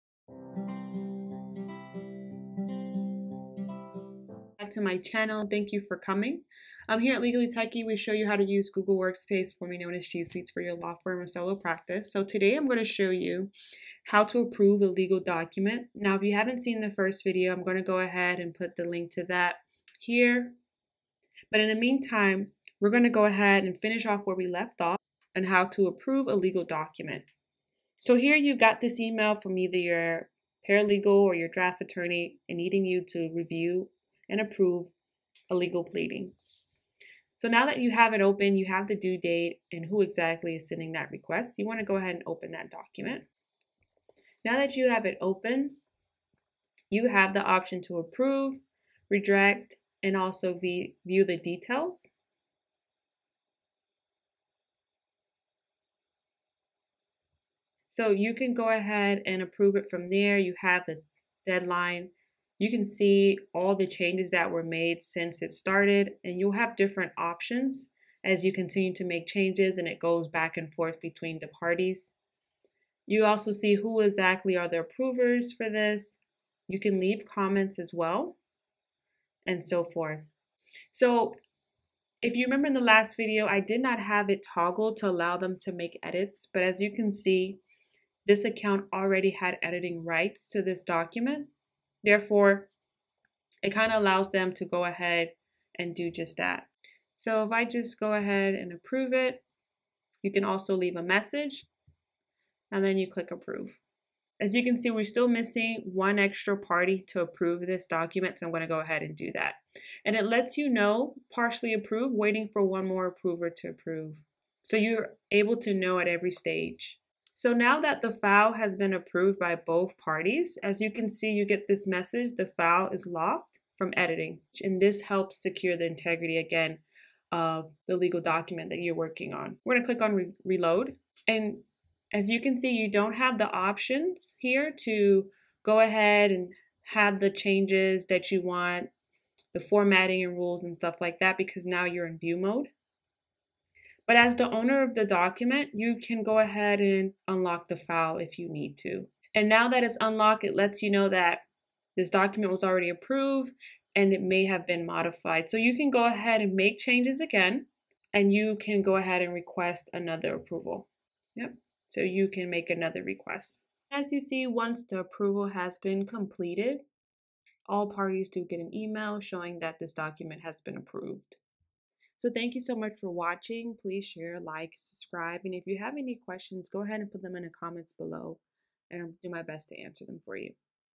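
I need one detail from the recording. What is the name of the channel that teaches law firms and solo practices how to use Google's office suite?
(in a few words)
Legally Techie.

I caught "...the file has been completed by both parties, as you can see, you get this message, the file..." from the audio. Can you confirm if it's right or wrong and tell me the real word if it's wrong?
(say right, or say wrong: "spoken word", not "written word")
wrong: "approved", not "completed".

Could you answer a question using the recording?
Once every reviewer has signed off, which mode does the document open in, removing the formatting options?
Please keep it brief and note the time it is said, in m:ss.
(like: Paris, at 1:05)
View mode, at 2:22.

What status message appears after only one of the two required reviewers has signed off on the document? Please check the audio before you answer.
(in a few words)
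Partially approved.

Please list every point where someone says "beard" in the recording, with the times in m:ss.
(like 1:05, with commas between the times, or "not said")
not said.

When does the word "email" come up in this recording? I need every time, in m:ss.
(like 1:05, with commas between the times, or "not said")
0:28, 2:48.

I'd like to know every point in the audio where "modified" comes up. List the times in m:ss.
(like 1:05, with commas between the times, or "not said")
2:34.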